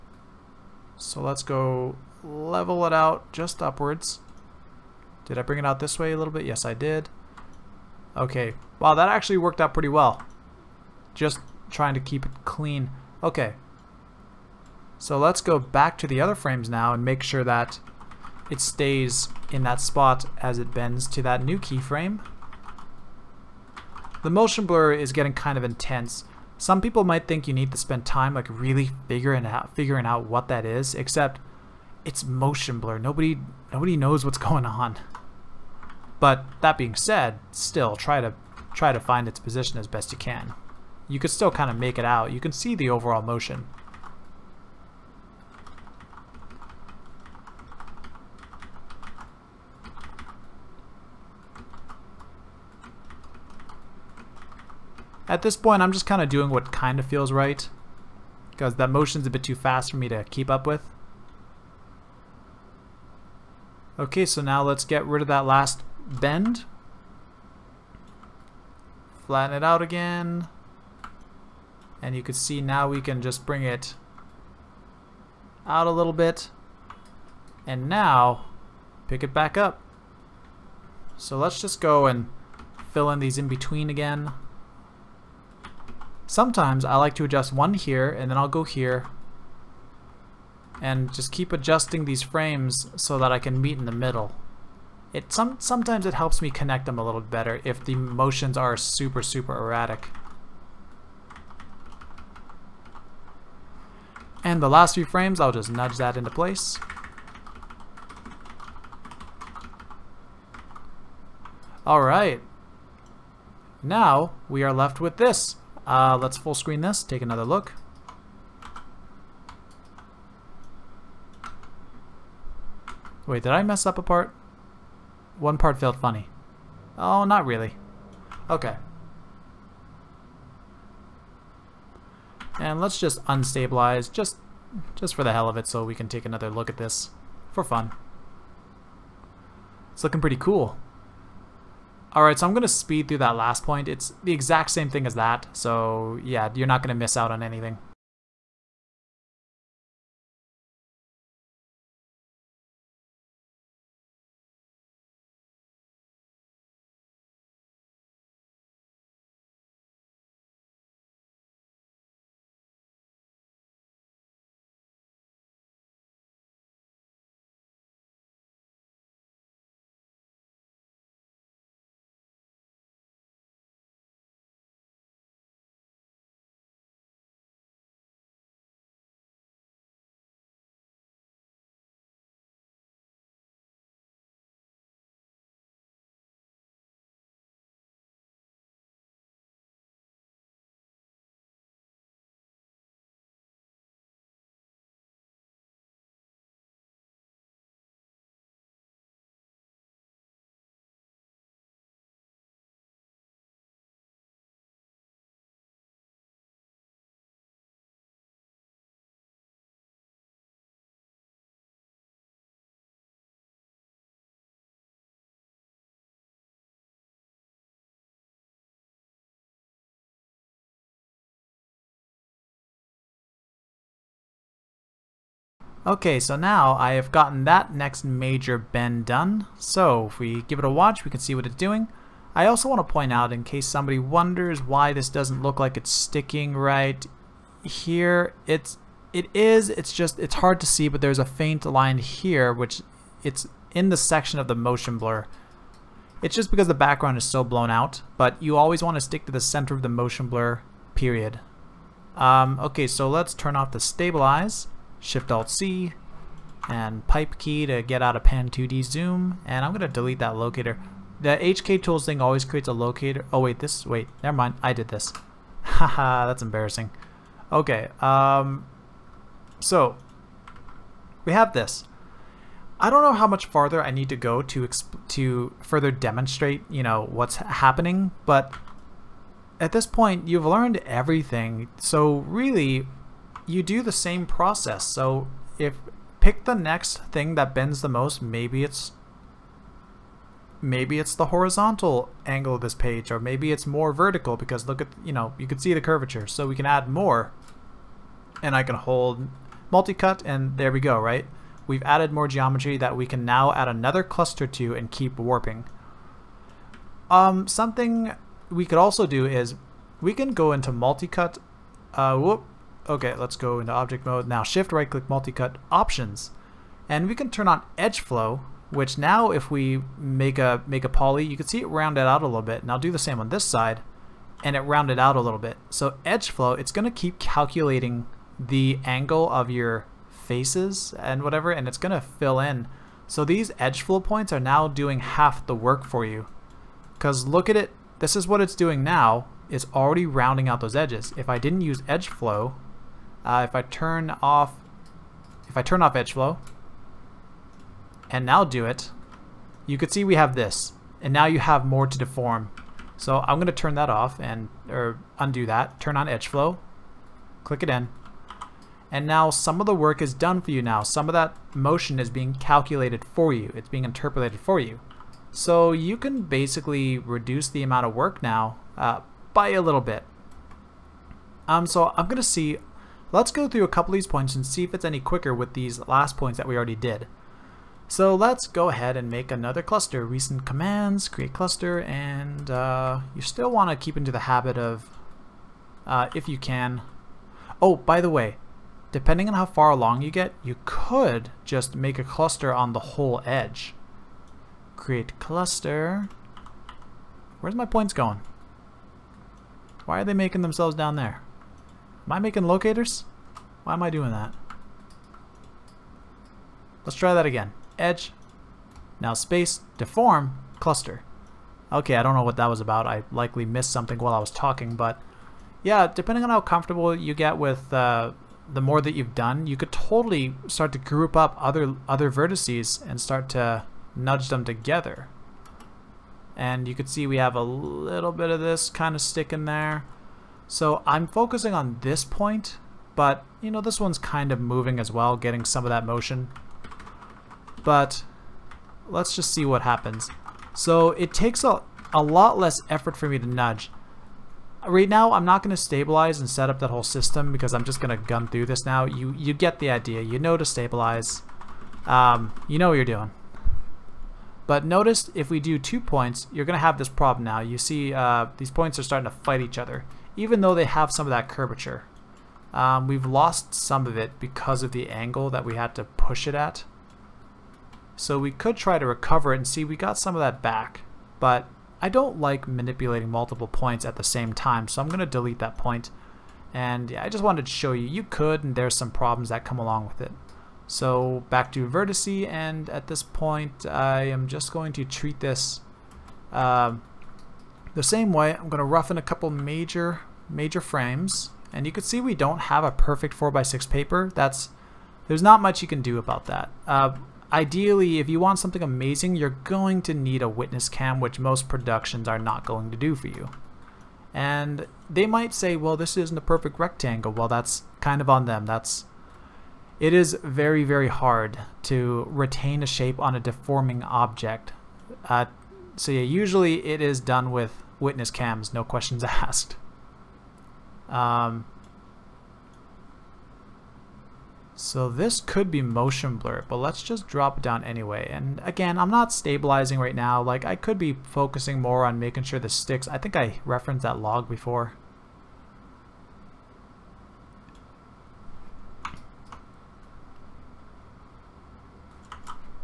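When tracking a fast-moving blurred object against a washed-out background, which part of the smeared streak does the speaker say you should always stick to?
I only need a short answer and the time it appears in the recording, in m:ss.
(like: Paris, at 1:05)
The center of the motion blur, at 4:09.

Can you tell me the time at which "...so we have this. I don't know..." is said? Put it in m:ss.
4:29.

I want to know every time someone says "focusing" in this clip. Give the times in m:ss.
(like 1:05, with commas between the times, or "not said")
7:11, 8:51.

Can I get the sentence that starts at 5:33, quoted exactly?
So these edge flow points are now doing half the work for you.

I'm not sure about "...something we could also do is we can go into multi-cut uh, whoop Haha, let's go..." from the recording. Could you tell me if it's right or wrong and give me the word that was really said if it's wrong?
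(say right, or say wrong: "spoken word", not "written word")
wrong: "Okay", not "Haha".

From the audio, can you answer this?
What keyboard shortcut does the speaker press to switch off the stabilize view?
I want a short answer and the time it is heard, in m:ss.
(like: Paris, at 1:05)
Shift-Alt-C, at 4:14.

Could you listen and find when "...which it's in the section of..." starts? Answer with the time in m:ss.
4:02.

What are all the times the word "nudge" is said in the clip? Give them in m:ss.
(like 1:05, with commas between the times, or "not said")
1:45, 7:03, 7:23.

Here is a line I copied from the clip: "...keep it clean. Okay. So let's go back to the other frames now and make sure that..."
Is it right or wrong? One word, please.
right.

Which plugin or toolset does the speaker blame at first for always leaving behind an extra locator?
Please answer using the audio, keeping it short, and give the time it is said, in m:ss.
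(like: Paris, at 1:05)
HK tools, at 4:21.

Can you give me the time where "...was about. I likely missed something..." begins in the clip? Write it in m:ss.
6:52.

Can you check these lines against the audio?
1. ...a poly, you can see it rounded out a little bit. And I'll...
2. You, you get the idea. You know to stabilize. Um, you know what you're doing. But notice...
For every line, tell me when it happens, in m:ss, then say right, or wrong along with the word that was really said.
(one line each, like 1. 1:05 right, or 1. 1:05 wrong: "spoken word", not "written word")
1. 5:20 right
2. 7:28 right.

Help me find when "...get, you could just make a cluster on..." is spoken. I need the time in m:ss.
6:30.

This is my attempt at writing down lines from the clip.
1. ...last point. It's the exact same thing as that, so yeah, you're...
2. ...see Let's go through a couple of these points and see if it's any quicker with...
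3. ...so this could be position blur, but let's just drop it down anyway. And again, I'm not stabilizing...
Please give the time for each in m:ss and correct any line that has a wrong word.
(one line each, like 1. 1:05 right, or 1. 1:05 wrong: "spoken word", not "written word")
1. 2:23 right
2. 6:12 right
3. 8:44 wrong: "motion", not "position".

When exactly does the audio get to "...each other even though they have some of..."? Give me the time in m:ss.
7:39.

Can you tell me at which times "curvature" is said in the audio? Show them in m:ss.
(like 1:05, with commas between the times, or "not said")
4:55, 7:41.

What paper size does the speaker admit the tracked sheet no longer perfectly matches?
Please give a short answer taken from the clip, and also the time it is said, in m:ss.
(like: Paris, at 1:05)
4x6, at 8:13.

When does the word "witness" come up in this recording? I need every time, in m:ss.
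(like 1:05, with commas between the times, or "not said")
8:20, 8:37.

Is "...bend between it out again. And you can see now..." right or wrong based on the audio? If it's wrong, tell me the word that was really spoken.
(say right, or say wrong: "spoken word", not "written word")
wrong: "flatten", not "between".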